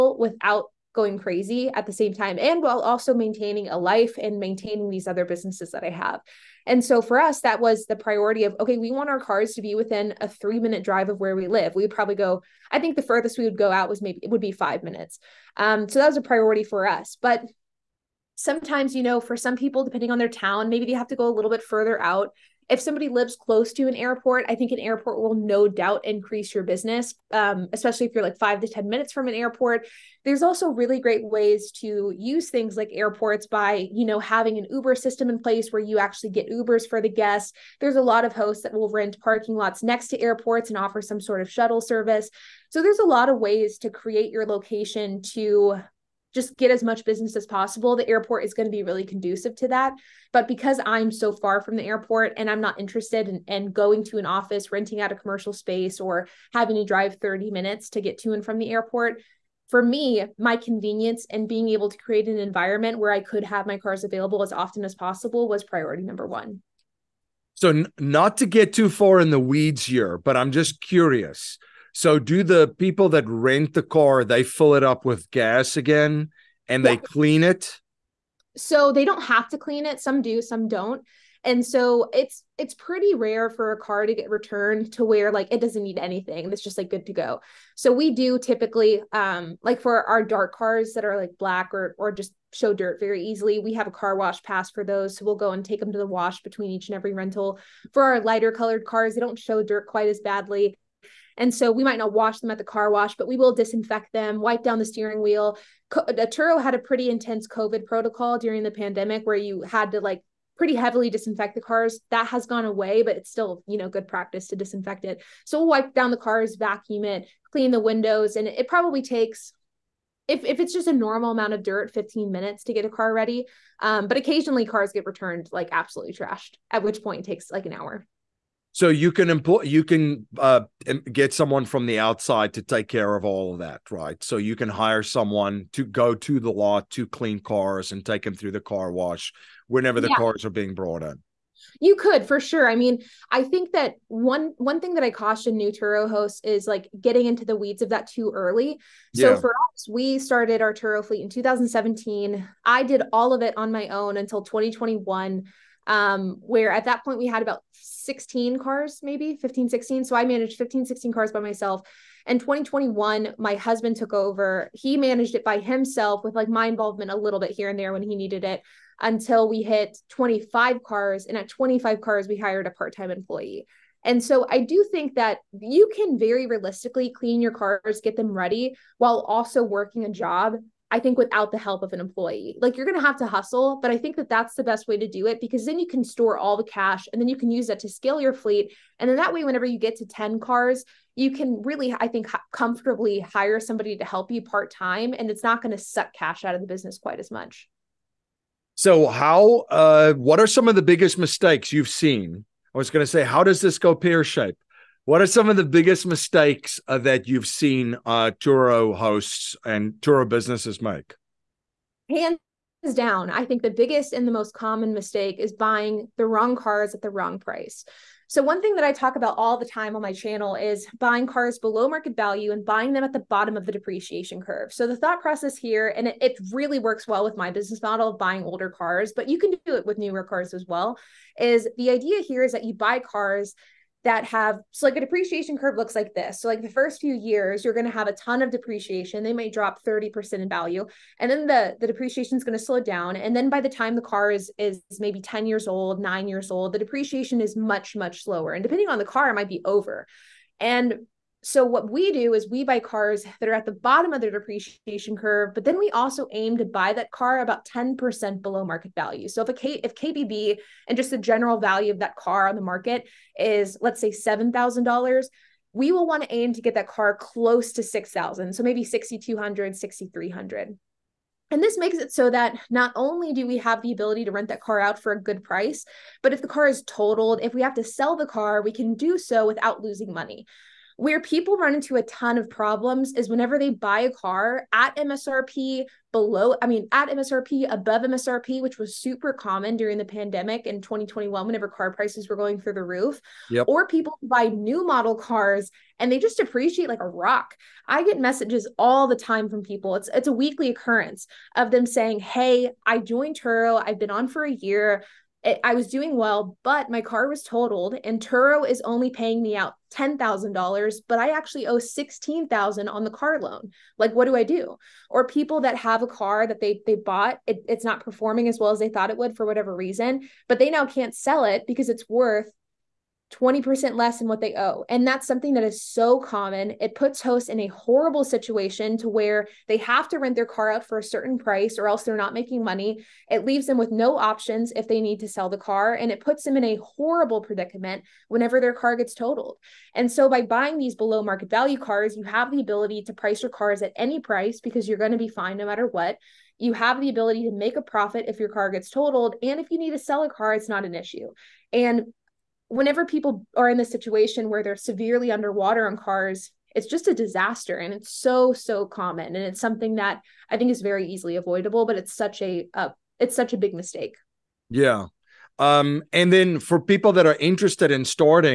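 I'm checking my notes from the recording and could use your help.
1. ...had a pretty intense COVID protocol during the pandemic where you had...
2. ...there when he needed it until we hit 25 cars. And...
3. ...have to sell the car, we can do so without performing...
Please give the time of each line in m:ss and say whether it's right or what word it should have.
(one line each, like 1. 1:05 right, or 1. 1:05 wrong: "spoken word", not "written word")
1. 1:46 right
2. 2:47 right
3. 4:37 wrong: "losing", not "performing".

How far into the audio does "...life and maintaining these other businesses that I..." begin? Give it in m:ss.
0:03.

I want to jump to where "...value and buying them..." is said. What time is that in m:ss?
3:42.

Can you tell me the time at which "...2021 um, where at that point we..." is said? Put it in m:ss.
2:34.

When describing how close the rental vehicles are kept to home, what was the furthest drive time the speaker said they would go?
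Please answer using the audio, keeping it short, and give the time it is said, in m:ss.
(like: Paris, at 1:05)
5 minutes, at 0:14.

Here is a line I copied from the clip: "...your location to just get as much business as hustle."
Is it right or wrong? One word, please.
wrong.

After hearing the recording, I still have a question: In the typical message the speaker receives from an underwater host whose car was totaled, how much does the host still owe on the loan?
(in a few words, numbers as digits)
16,000.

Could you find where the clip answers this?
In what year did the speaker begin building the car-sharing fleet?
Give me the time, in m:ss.
2:31.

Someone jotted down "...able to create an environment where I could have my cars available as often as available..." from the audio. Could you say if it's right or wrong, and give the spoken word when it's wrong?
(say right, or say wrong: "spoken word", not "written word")
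wrong: "possible", not "available".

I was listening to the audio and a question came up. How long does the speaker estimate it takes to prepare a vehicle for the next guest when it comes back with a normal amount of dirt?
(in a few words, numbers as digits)
15 minutes.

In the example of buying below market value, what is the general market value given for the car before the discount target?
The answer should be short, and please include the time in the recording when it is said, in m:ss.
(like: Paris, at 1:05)
$7,000, at 4:24.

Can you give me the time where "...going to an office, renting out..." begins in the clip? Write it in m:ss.
0:53.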